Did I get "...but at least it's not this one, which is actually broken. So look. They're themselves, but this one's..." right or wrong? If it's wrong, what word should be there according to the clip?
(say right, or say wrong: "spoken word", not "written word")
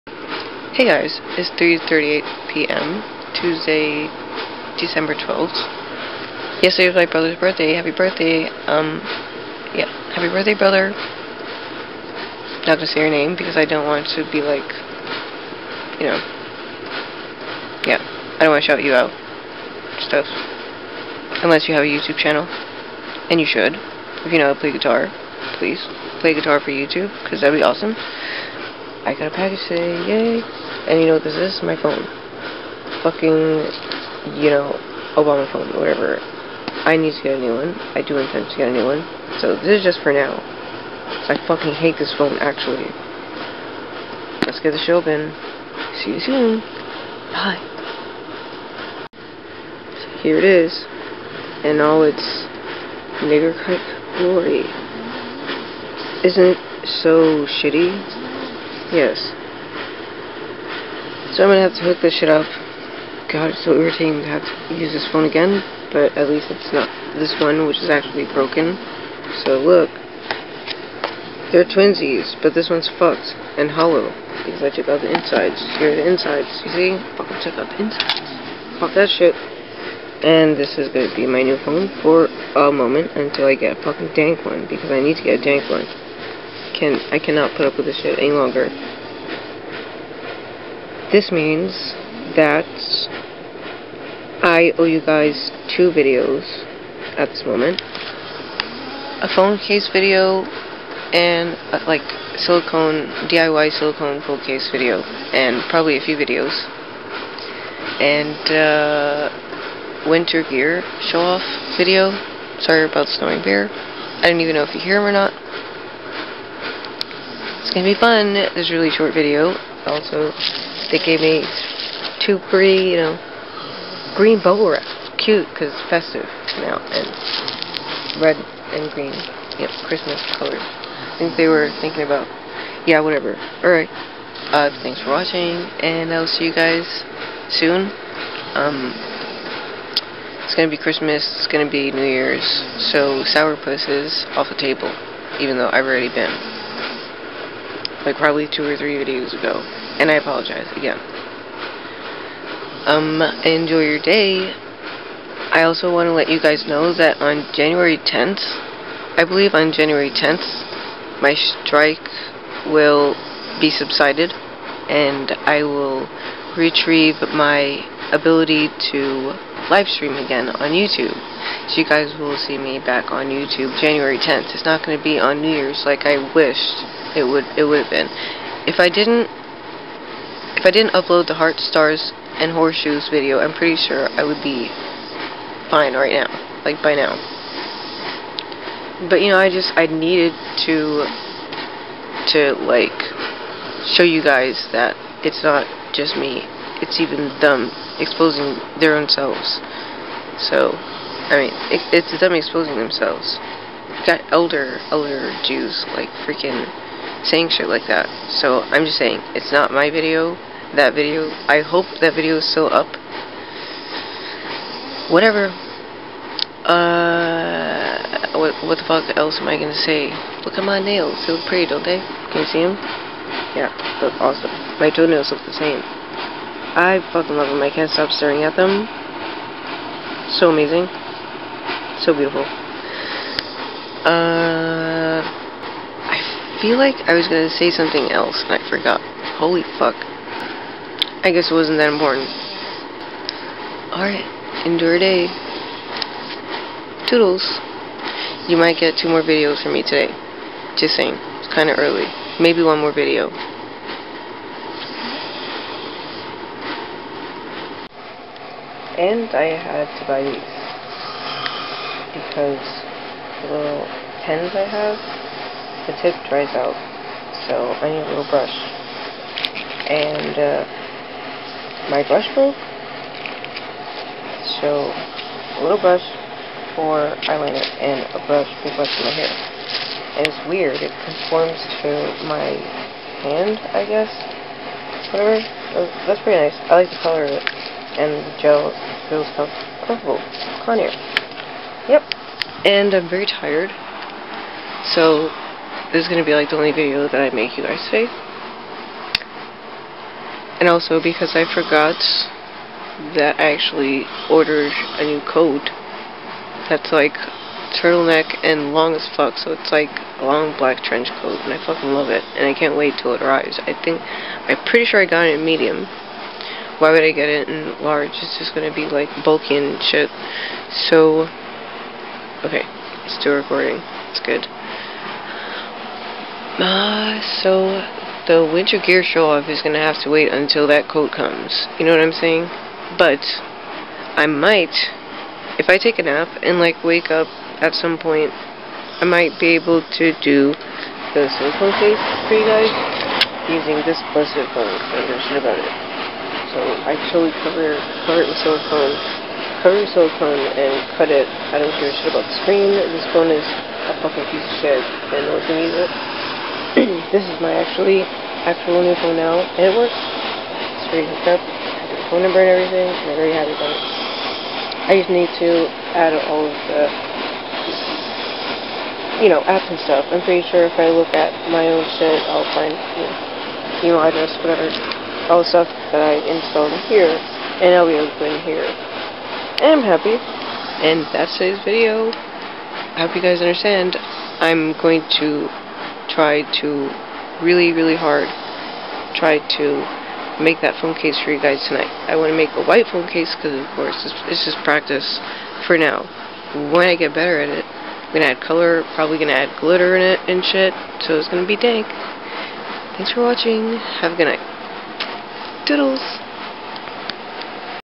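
wrong: "twinsies", not "themselves".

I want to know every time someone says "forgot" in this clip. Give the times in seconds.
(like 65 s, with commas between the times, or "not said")
238 s, 301 s.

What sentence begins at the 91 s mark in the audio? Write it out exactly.
This means that I owe you guys two videos at this moment.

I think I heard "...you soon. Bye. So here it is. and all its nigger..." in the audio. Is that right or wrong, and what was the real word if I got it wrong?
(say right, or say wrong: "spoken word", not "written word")
right.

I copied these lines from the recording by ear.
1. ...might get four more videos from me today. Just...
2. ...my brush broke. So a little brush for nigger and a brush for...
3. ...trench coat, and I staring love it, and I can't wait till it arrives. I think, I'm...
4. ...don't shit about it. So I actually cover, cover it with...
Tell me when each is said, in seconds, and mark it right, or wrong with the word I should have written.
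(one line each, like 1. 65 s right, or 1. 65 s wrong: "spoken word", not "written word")
1. 248 s wrong: "two", not "four"
2. 271 s wrong: "eyeliner", not "nigger"
3. 310 s wrong: "fucking", not "staring"
4. 345 s right.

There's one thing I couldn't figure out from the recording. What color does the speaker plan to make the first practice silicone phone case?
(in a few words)
White.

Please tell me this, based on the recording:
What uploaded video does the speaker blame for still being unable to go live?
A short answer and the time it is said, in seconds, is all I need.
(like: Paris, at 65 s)
Heart stars and horseshoes, at 181 s.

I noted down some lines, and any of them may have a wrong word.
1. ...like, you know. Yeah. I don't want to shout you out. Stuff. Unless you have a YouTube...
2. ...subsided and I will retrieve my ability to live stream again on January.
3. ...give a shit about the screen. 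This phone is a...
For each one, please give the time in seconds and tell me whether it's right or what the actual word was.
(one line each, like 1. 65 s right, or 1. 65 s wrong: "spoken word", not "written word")
1. 14 s right
2. 163 s wrong: "YouTube", not "January"
3. 351 s right.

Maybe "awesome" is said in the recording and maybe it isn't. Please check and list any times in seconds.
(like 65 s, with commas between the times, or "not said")
27 s, 224 s.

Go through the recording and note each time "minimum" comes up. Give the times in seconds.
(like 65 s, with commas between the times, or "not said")
not said.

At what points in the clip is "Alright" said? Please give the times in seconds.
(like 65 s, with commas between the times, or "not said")
133 s, 243 s.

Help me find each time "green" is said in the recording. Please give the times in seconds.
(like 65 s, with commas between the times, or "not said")
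124 s, 128 s.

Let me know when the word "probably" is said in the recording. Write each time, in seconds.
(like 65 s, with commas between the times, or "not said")
105 s, 148 s, 398 s.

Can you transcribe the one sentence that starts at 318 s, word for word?
It's just gonna be like bulky and shit.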